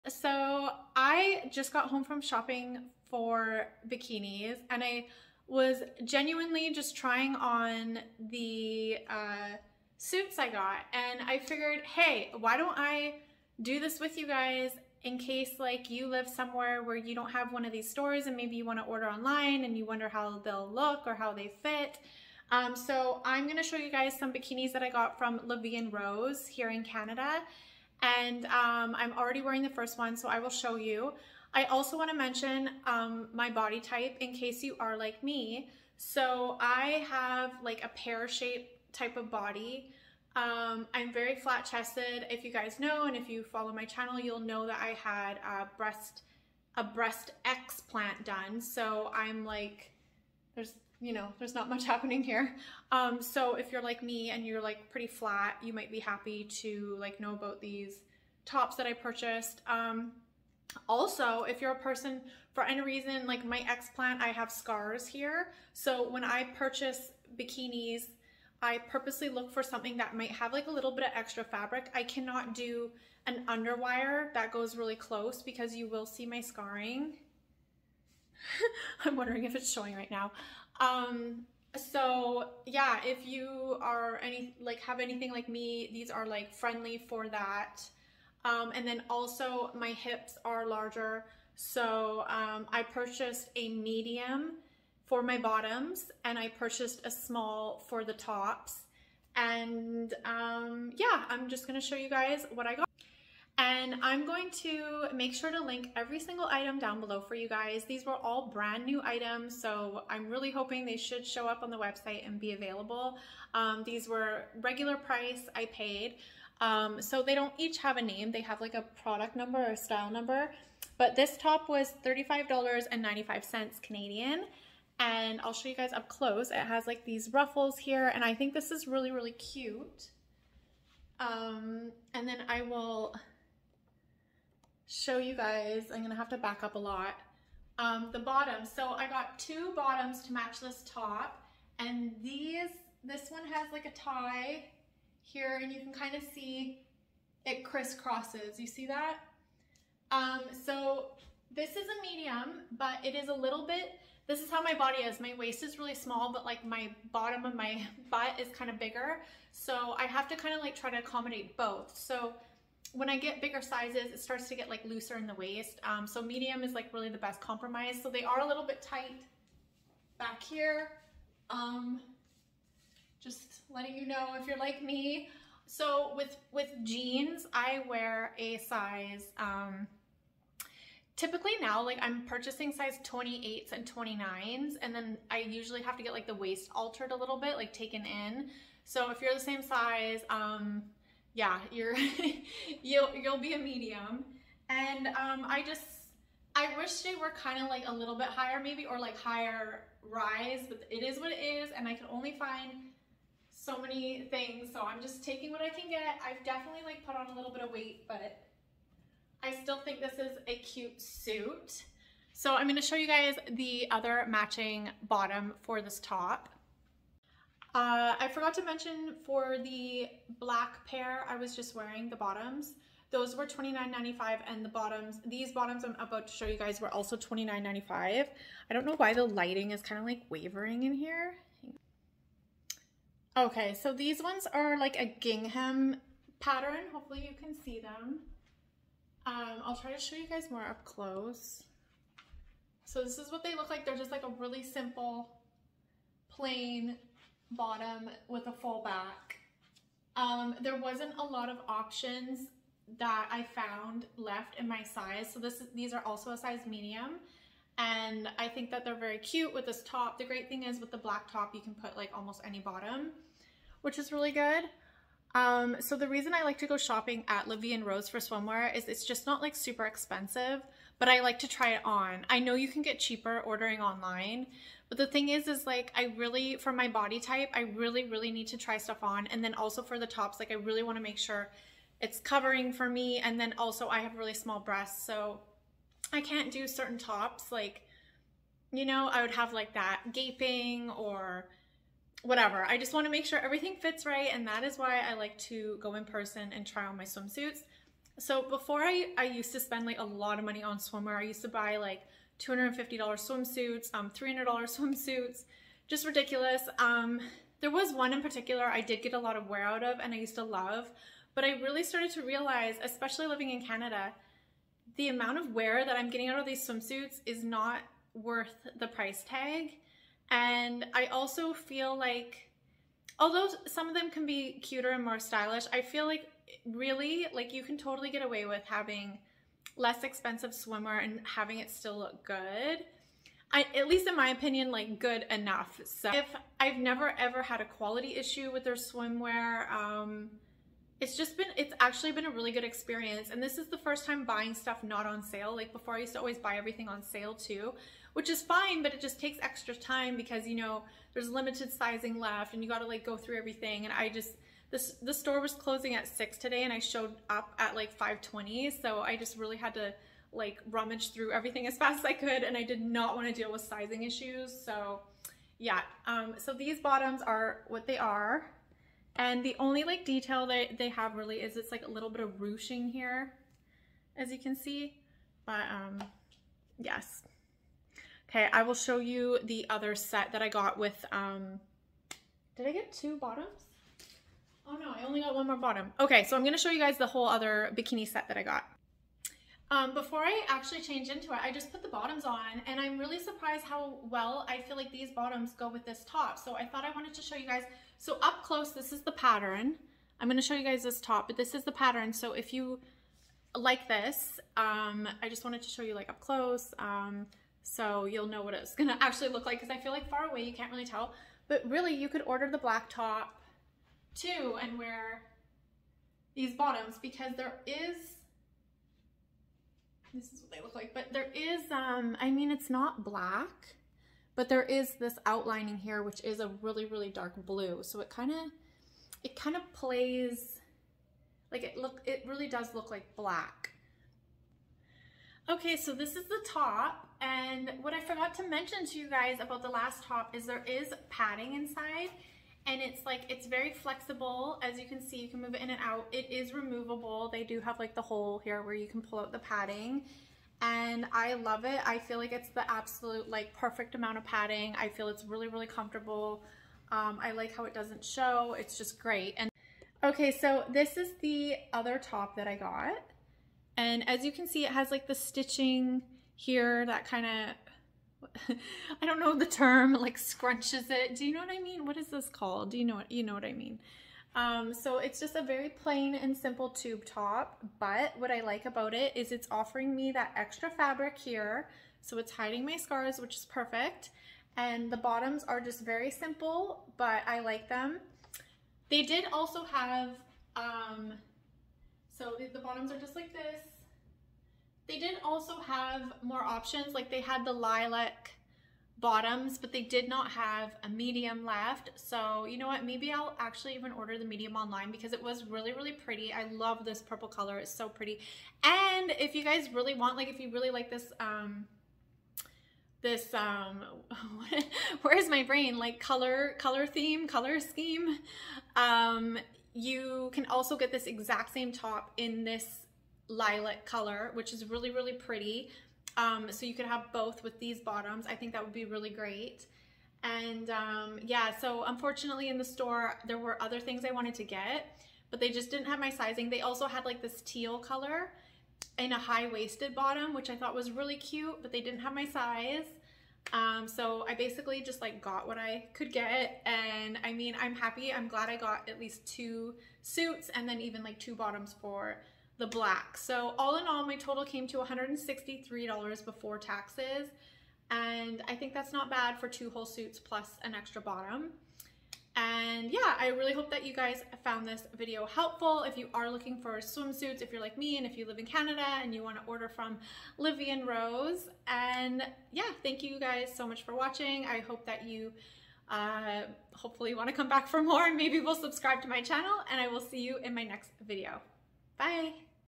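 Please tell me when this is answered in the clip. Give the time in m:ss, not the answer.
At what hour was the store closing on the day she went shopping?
5:56.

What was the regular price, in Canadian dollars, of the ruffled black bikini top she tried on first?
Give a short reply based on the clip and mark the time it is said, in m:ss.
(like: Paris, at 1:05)
$35.95, at 2:02.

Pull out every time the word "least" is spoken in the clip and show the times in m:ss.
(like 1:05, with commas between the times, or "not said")
5:33, 9:08.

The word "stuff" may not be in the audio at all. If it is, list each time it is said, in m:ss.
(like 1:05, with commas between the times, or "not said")
4:38, 5:44.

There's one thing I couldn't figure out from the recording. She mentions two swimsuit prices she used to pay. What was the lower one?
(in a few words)
$250.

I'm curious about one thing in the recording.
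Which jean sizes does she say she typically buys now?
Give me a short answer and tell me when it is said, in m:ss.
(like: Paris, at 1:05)
28s and 29s, at 3:03.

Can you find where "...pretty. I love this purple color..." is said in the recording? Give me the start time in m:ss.
8:25.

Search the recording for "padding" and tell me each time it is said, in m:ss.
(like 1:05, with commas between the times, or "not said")
7:21, 7:29, 7:34.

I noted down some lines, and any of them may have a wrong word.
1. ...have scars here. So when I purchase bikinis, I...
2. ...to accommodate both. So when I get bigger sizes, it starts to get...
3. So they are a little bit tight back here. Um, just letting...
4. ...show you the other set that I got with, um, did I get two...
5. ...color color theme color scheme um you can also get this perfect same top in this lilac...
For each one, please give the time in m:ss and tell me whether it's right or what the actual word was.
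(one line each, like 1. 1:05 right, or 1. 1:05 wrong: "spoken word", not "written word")
1. 1:04 right
2. 2:40 right
3. 2:48 right
4. 6:18 right
5. 8:35 wrong: "exact", not "perfect".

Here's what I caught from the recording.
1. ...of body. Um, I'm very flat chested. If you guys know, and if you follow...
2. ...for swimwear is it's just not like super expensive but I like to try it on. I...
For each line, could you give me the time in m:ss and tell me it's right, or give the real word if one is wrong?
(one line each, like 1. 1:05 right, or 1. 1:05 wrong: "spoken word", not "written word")
1. 0:39 right
2. 4:28 right.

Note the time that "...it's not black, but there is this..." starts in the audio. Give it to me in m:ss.
7:02.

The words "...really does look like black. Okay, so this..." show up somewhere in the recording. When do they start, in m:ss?
7:12.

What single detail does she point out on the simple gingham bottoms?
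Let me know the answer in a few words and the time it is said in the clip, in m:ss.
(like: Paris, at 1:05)
Ruching, at 6:12.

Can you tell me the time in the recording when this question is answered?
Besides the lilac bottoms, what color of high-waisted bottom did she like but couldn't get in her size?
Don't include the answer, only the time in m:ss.
8:57.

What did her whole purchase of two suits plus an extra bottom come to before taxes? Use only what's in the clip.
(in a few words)
$163.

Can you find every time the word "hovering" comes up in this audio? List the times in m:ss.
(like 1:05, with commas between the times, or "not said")
not said.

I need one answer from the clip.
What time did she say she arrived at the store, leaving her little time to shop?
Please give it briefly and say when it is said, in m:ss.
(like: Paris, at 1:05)
5:20, at 5:57.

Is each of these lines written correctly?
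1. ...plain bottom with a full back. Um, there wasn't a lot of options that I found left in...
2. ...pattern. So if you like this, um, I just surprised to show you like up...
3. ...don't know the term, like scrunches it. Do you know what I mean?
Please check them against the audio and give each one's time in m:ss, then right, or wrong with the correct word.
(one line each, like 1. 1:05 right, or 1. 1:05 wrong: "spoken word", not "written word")
1. 4:06 right
2. 6:41 wrong: "wanted", not "surprised"
3. 7:49 right.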